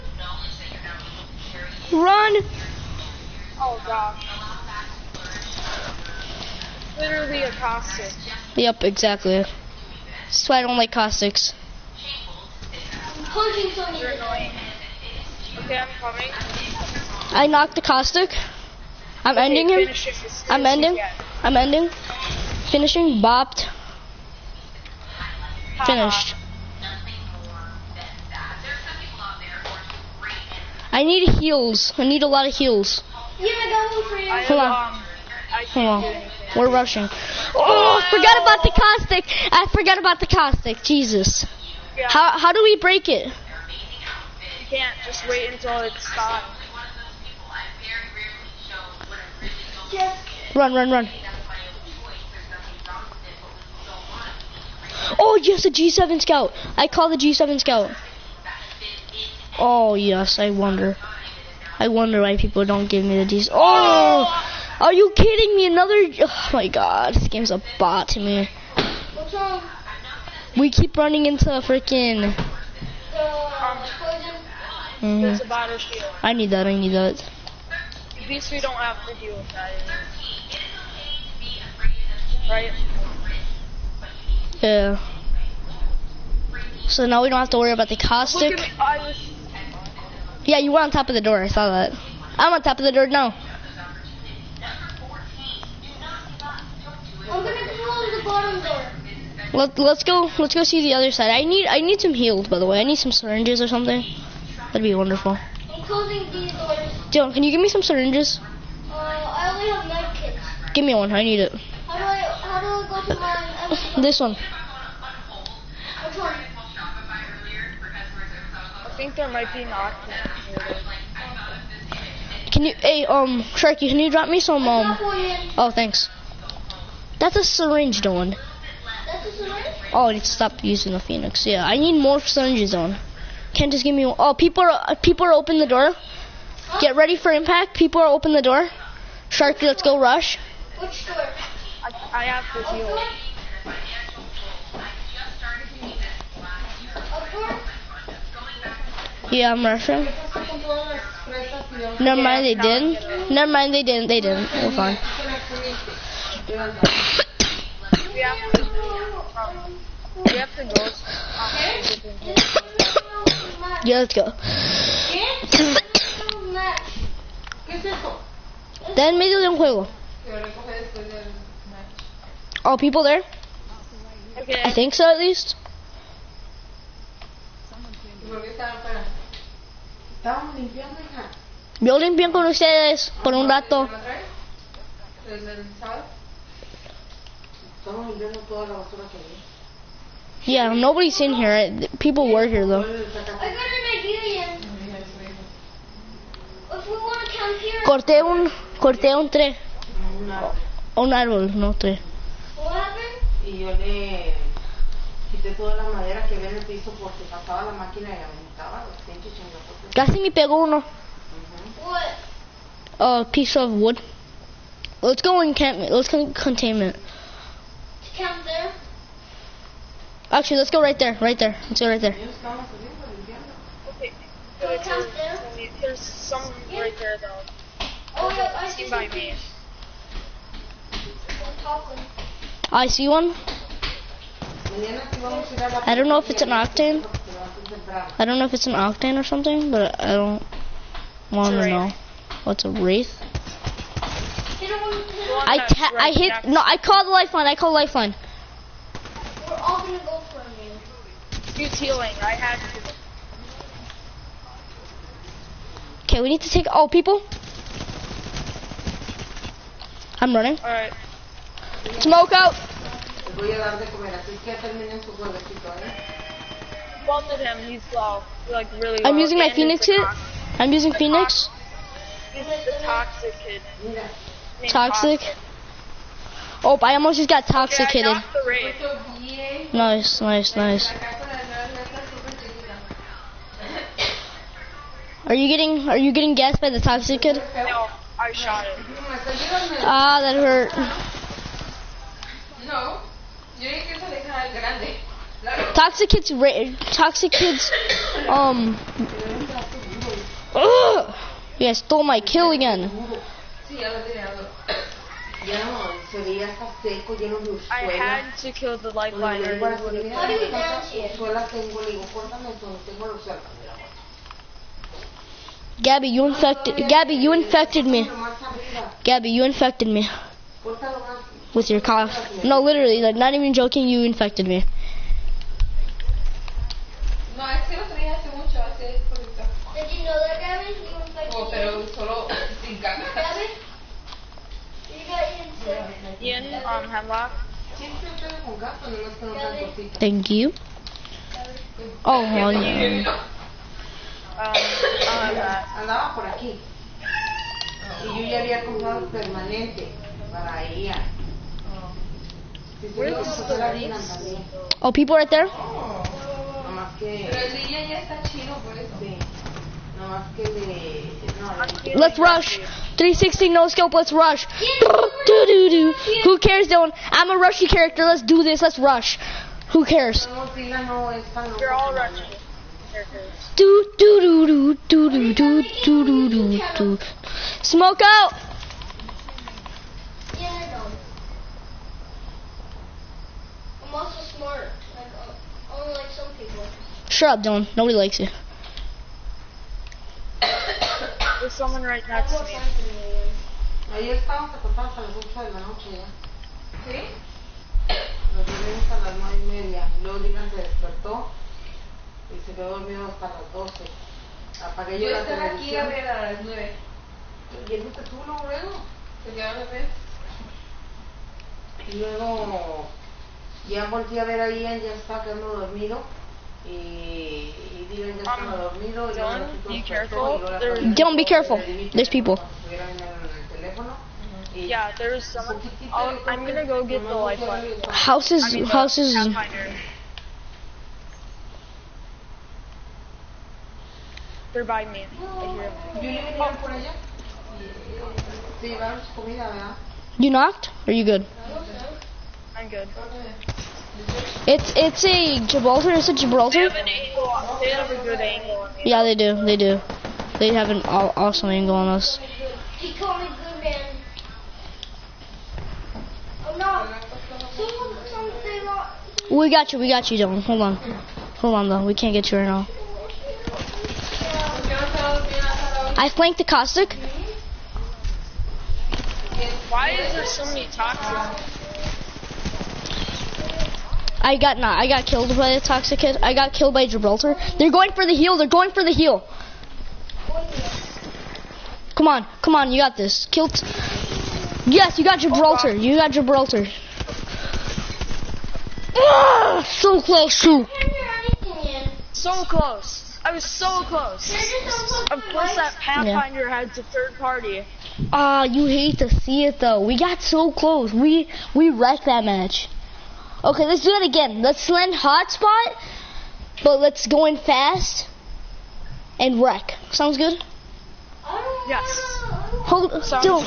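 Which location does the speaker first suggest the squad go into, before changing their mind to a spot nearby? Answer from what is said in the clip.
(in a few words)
containment.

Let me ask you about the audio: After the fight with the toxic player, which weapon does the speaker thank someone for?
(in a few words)
Hemlock.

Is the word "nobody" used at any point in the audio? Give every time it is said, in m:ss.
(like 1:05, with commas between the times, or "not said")
3:10, 6:27.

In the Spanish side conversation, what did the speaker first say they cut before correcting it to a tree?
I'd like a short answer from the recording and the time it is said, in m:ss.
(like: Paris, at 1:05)
un tres, at 3:19.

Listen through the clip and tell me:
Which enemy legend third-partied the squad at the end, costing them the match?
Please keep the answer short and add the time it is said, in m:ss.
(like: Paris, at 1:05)
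Pathfinder, at 8:15.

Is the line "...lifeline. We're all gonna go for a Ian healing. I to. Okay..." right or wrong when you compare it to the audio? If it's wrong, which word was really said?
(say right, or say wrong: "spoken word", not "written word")
wrong: "Use", not "Ian".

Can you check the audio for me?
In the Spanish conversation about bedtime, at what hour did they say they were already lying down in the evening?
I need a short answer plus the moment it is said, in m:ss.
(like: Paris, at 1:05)
8, at 6:35.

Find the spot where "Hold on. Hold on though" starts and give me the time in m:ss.
7:40.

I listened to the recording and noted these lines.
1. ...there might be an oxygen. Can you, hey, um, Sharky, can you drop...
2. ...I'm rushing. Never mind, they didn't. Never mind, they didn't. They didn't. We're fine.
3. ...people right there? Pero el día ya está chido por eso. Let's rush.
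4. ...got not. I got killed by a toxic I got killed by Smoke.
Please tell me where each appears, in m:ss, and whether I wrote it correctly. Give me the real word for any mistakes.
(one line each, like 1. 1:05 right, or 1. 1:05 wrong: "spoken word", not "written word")
1. 1:59 right
2. 2:29 right
3. 5:54 right
4. 7:54 wrong: "Gibraltar", not "Smoke".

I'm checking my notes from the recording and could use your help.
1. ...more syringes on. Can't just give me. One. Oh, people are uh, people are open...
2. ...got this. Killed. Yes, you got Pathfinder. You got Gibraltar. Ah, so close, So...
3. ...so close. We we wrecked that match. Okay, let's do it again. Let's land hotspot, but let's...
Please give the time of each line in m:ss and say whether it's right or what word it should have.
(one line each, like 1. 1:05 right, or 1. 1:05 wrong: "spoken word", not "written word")
1. 2:12 right
2. 8:02 wrong: "Gibraltar", not "Pathfinder"
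3. 8:20 right.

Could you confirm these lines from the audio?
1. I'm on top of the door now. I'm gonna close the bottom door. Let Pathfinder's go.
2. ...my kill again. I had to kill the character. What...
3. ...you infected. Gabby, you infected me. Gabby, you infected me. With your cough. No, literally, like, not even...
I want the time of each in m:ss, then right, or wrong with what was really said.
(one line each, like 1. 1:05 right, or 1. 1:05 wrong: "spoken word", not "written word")
1. 1:32 wrong: "Let", not "Pathfinder"
2. 5:02 wrong: "lifeliner", not "character"
3. 5:16 right.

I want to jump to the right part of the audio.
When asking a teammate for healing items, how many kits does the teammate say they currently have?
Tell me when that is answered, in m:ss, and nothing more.
1:49.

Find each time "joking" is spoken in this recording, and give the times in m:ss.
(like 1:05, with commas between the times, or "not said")
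5:23.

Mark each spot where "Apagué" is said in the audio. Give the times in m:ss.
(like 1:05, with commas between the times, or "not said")
6:44.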